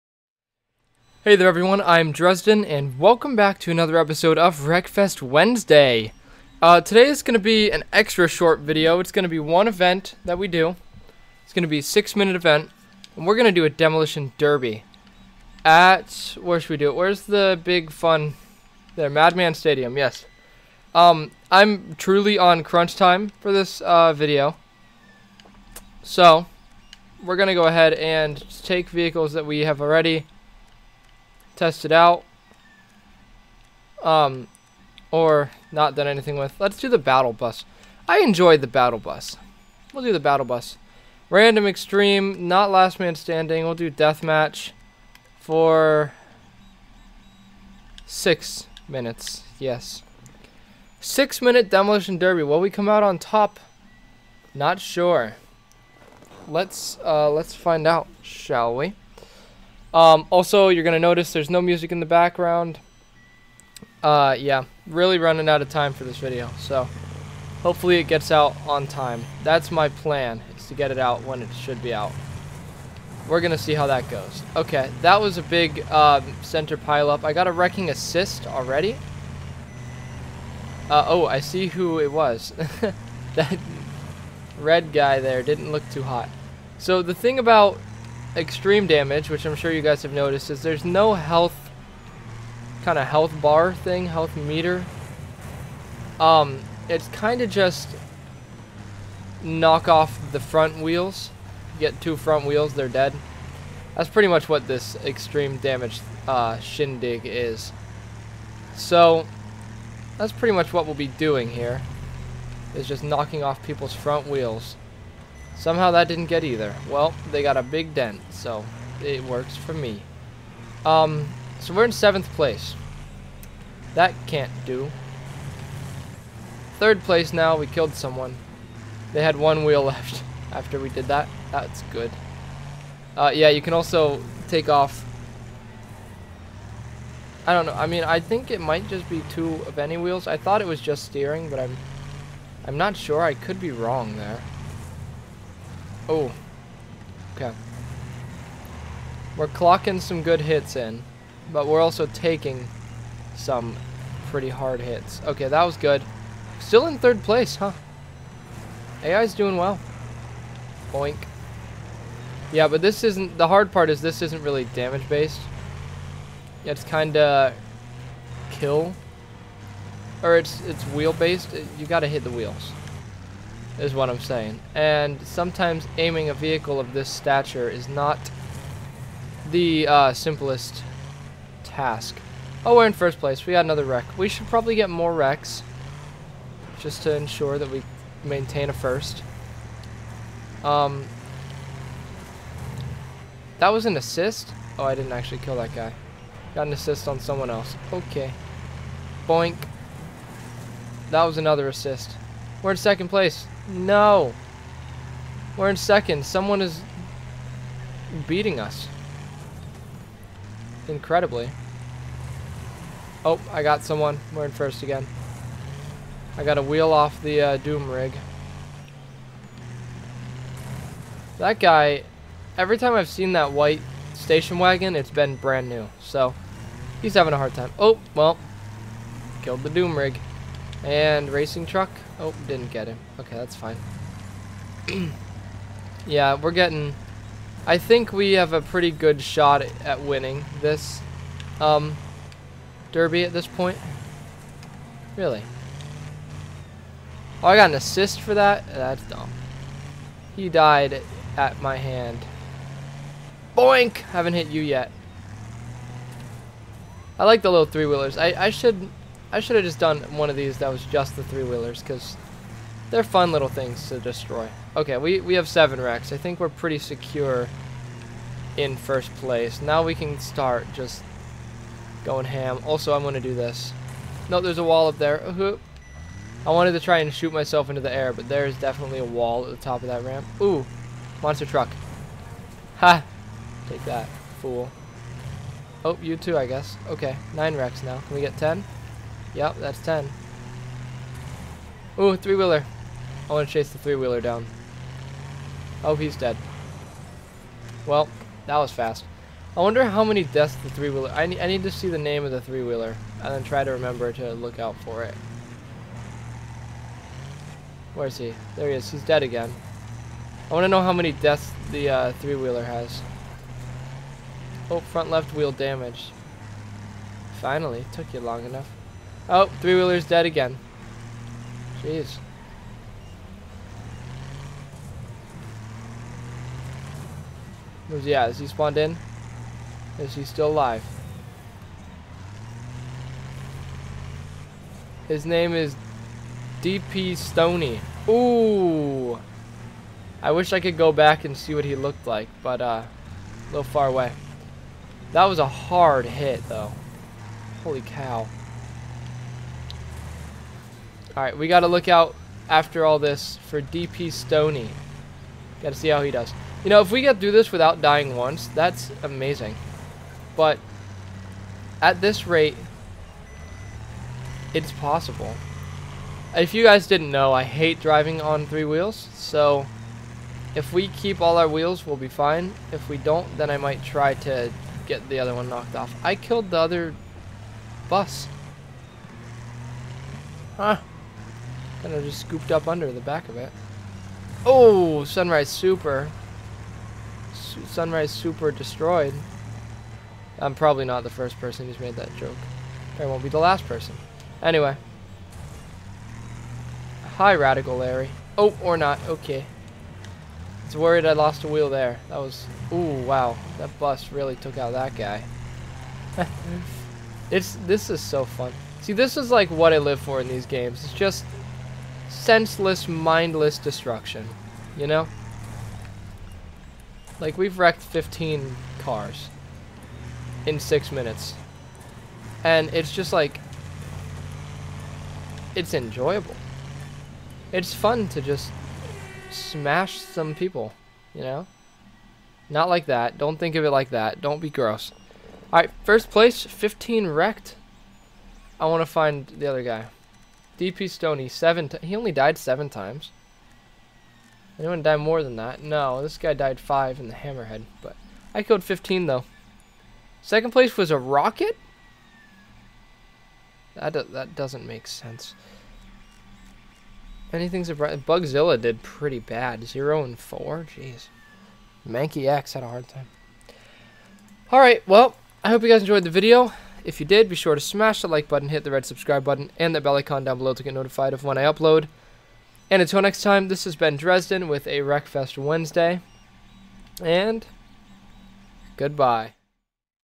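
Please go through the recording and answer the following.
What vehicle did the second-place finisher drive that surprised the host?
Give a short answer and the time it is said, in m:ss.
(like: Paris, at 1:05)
A rocket, at 7:30.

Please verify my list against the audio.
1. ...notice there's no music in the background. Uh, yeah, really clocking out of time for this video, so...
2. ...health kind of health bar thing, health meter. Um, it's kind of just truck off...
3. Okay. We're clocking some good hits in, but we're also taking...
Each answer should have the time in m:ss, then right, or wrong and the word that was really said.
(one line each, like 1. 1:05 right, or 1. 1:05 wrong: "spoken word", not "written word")
1. 1:00 wrong: "running", not "clocking"
2. 1:31 wrong: "knock", not "truck"
3. 2:27 right.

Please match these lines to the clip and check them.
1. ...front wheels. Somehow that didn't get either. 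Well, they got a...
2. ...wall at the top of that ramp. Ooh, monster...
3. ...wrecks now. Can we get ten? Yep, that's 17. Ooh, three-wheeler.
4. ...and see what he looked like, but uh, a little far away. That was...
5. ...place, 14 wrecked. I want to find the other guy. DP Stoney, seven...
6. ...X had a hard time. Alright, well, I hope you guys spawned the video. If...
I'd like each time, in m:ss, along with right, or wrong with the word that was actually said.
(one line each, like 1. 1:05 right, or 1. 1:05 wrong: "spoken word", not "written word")
1. 1:53 right
2. 4:39 right
3. 4:47 wrong: "10", not "17"
4. 5:41 right
5. 7:16 wrong: "15", not "14"
6. 7:42 wrong: "enjoyed", not "spawned".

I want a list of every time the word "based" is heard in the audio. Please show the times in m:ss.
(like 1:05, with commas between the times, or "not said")
2:44, 2:50.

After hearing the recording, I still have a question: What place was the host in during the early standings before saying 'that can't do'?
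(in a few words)
7th.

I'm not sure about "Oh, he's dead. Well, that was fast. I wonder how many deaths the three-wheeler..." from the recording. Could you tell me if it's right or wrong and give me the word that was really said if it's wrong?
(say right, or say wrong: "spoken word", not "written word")
right.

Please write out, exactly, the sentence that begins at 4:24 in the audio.
Okay, we, we have seven wrecks.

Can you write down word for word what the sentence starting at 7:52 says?
And until next time, this has been Dresden with a Wreckfest Wednesday.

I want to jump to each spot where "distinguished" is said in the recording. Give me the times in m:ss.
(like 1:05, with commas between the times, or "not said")
not said.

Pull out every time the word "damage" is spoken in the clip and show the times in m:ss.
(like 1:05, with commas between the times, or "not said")
1:28, 1:45, 2:44, 5:15.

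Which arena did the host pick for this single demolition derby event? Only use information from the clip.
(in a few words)
Madman Stadium.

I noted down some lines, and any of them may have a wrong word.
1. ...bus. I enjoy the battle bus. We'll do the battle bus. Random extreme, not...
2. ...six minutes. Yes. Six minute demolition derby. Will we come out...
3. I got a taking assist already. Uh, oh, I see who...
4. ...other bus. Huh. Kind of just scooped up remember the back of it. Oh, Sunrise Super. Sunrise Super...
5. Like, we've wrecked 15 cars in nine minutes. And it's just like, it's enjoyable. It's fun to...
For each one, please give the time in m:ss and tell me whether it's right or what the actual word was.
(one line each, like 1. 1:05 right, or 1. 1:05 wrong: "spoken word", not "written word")
1. 0:37 right
2. 0:48 right
3. 1:17 wrong: "wrecking", not "taking"
4. 6:16 wrong: "under", not "remember"
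5. 6:57 wrong: "six", not "nine".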